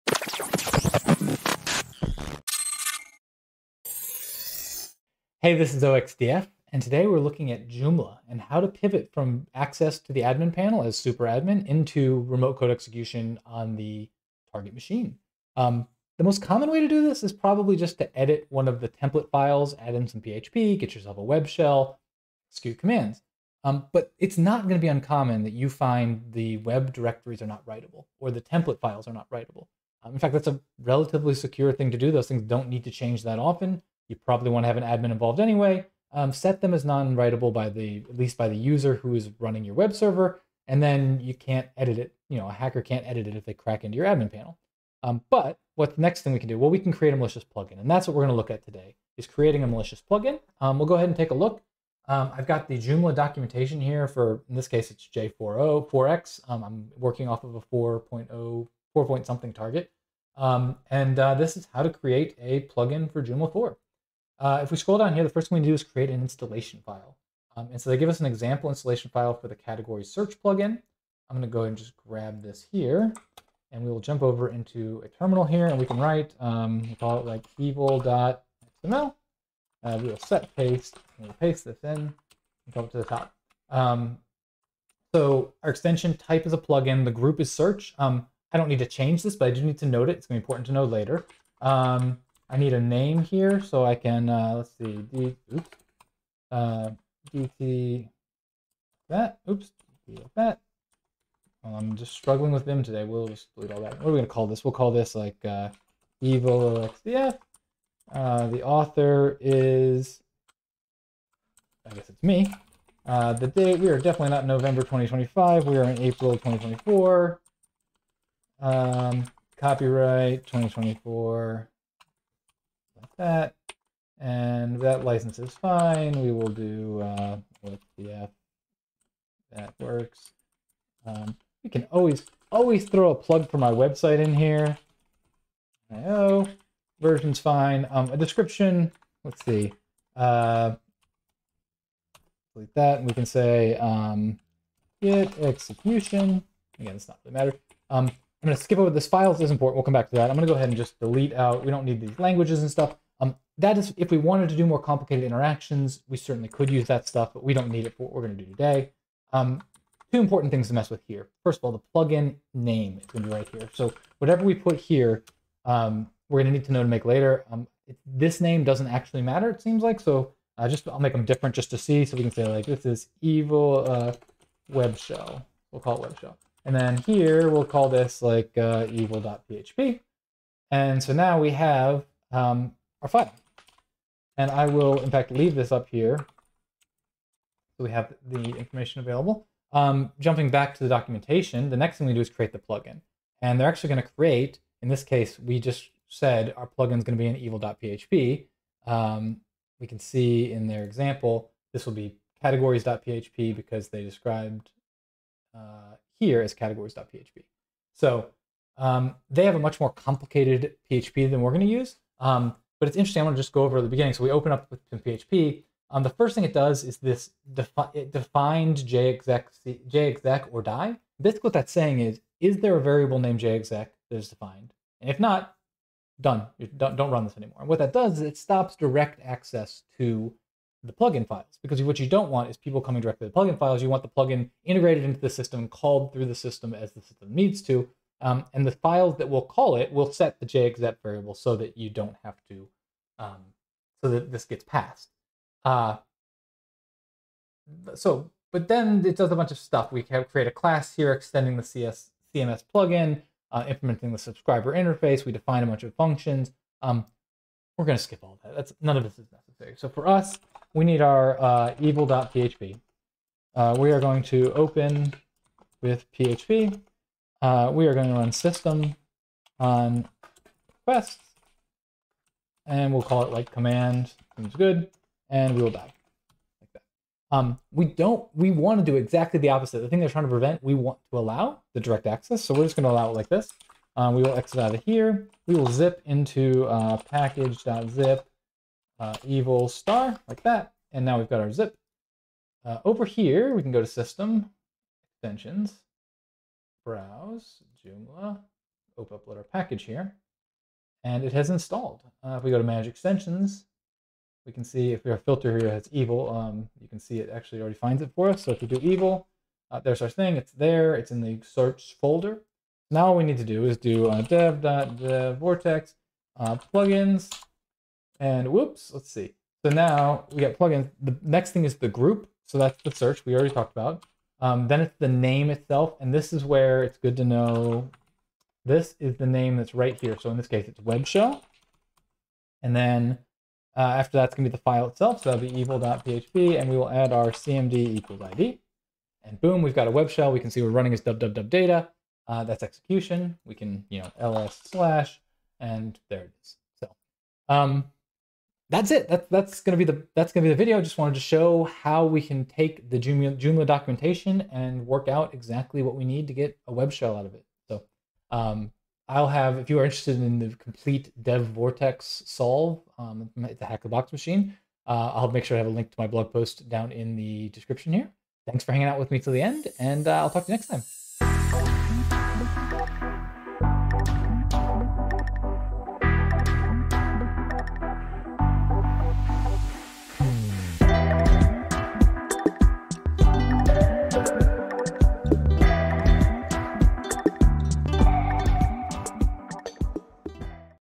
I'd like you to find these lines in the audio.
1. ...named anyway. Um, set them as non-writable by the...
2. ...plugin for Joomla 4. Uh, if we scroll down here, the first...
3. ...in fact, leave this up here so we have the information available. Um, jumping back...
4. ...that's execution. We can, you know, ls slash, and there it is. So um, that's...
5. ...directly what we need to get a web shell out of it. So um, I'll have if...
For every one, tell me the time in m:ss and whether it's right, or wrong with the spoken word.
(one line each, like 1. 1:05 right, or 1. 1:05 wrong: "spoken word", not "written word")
1. 0:35 wrong: "involved", not "named"
2. 1:02 right
3. 3:05 right
4. 5:42 right
5. 5:55 wrong: "exactly", not "directly".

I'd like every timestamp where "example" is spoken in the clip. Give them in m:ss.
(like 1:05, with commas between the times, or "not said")
1:08, 3:20.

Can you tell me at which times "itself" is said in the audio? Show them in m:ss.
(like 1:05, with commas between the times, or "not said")
5:25, 5:34.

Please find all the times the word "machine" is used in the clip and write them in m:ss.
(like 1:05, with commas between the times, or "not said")
0:14, 6:04.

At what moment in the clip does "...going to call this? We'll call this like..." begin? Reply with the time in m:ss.
1:44.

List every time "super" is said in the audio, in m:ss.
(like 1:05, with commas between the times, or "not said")
0:10.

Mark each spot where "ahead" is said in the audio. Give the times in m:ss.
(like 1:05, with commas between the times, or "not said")
0:50, 1:11, 2:30.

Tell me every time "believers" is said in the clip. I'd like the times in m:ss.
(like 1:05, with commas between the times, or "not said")
not said.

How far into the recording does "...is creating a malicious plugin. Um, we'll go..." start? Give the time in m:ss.
0:49.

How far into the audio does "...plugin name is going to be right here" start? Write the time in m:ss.
2:41.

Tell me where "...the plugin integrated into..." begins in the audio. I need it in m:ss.
3:54.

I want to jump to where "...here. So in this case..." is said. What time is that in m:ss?
5:30.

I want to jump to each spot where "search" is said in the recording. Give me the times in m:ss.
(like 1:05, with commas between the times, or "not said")
1:10, 1:27, 5:11, 5:22.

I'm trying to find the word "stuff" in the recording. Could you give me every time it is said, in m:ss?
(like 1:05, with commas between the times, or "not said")
2:32, 2:37, 4:09.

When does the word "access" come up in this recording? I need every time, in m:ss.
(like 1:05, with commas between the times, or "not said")
0:09, 3:49, 4:42.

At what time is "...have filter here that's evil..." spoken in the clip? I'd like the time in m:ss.
5:05.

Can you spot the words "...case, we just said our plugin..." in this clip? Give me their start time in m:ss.
3:15.